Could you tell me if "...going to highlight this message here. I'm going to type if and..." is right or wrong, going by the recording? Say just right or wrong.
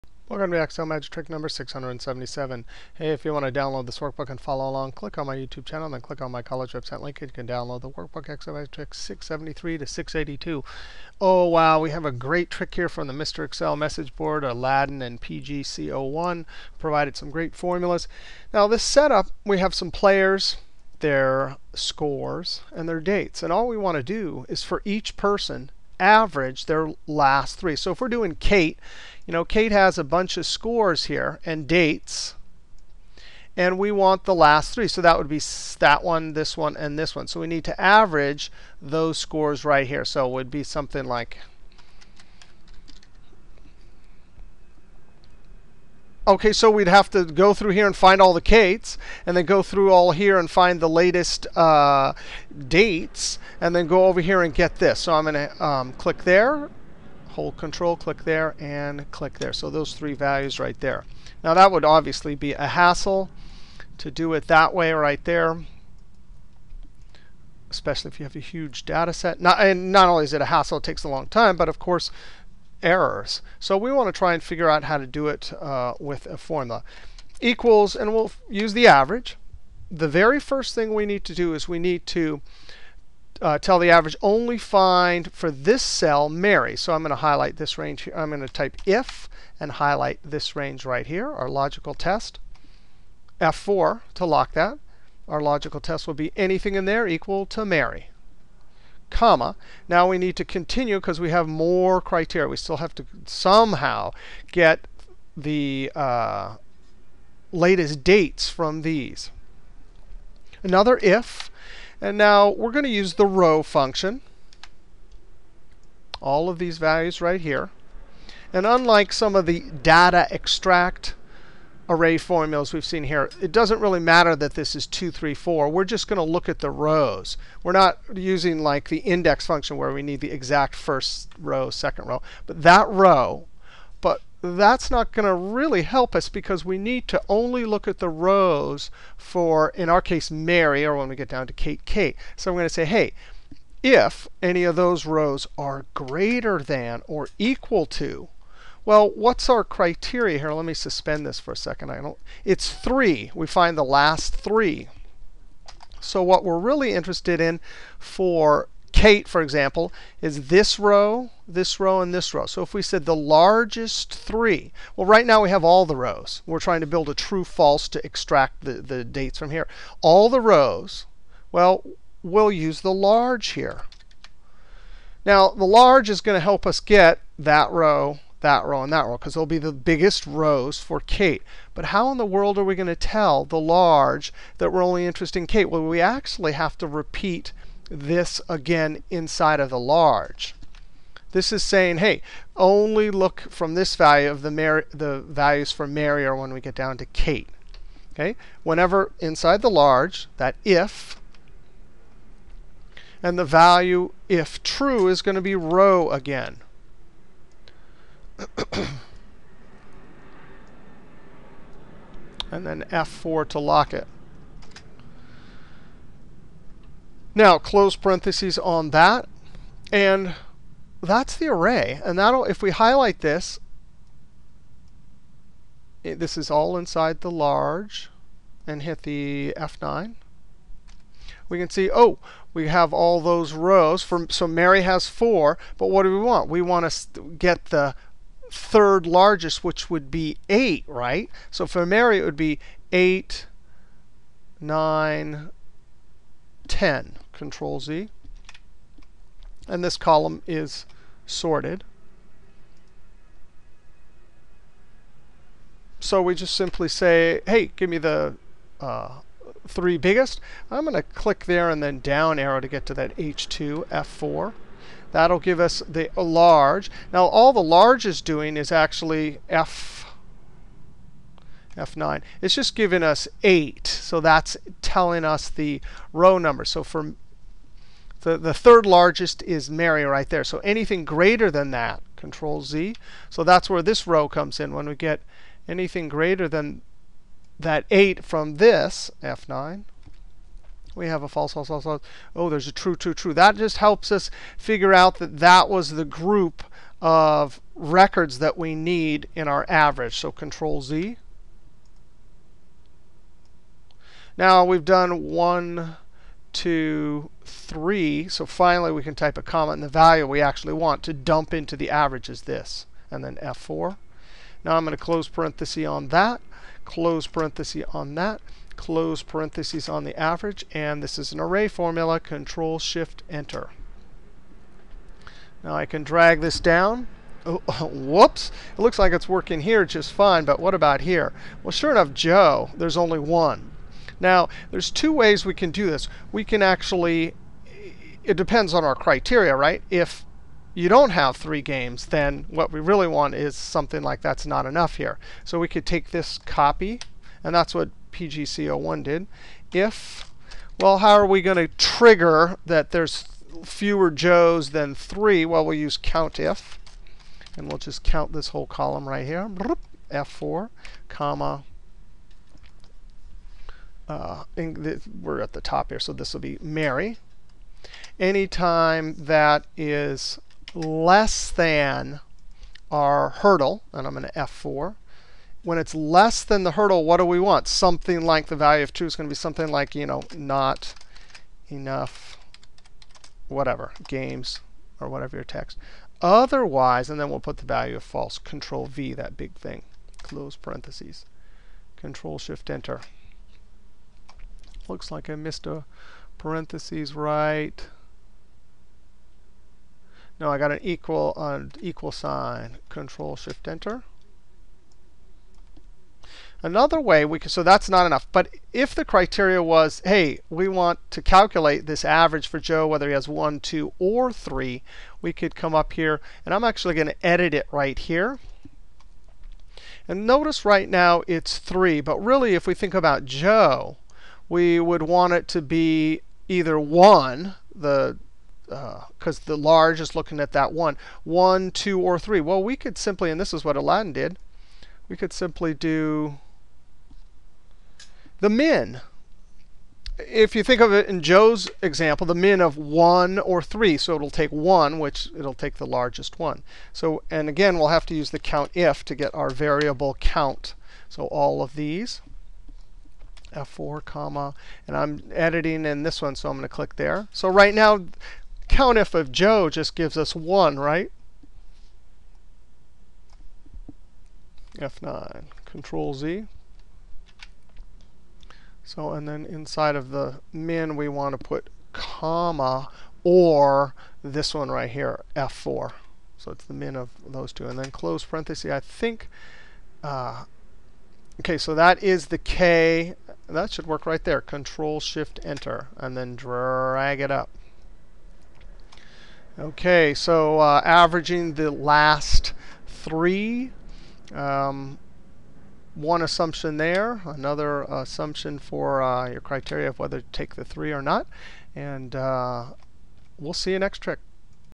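wrong.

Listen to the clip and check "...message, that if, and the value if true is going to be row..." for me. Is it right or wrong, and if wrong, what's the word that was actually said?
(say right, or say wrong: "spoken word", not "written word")
wrong: "large", not "message".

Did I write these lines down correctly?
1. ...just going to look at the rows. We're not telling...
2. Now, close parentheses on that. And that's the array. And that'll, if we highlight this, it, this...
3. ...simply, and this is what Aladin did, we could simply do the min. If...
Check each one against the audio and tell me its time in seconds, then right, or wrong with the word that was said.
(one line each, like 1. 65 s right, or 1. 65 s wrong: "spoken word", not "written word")
1. 125 s wrong: "using", not "telling"
2. 217 s right
3. 432 s right.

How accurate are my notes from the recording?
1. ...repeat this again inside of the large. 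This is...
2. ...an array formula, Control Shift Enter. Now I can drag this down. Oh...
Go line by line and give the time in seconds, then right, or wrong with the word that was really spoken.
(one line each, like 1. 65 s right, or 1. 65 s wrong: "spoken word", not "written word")
1. 186 s right
2. 321 s right.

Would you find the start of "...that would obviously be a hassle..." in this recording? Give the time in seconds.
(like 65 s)
61 s.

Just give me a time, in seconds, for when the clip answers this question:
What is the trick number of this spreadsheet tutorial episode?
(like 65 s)
1 s.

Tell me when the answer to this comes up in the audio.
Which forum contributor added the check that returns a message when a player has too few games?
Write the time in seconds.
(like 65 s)
348 s.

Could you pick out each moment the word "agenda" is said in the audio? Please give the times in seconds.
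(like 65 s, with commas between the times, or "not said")
not said.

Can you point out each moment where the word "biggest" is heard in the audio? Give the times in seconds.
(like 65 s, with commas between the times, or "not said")
179 s, 259 s.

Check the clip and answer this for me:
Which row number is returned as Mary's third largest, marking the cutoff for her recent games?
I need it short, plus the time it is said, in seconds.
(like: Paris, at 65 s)
8, at 240 s.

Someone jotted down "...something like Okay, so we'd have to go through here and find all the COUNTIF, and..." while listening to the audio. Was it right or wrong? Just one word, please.
wrong.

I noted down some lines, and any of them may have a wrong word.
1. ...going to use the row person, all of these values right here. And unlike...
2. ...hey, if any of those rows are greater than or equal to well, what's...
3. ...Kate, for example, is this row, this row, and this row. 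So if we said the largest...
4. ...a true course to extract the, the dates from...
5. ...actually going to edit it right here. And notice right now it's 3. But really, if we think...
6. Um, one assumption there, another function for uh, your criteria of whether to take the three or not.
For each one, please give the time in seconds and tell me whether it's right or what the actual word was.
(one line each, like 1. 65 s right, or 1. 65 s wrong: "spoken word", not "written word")
1. 112 s wrong: "function", not "person"
2. 142 s right
3. 158 s right
4. 167 s wrong: "false", not "course"
5. 416 s right
6. 494 s wrong: "assumption", not "function".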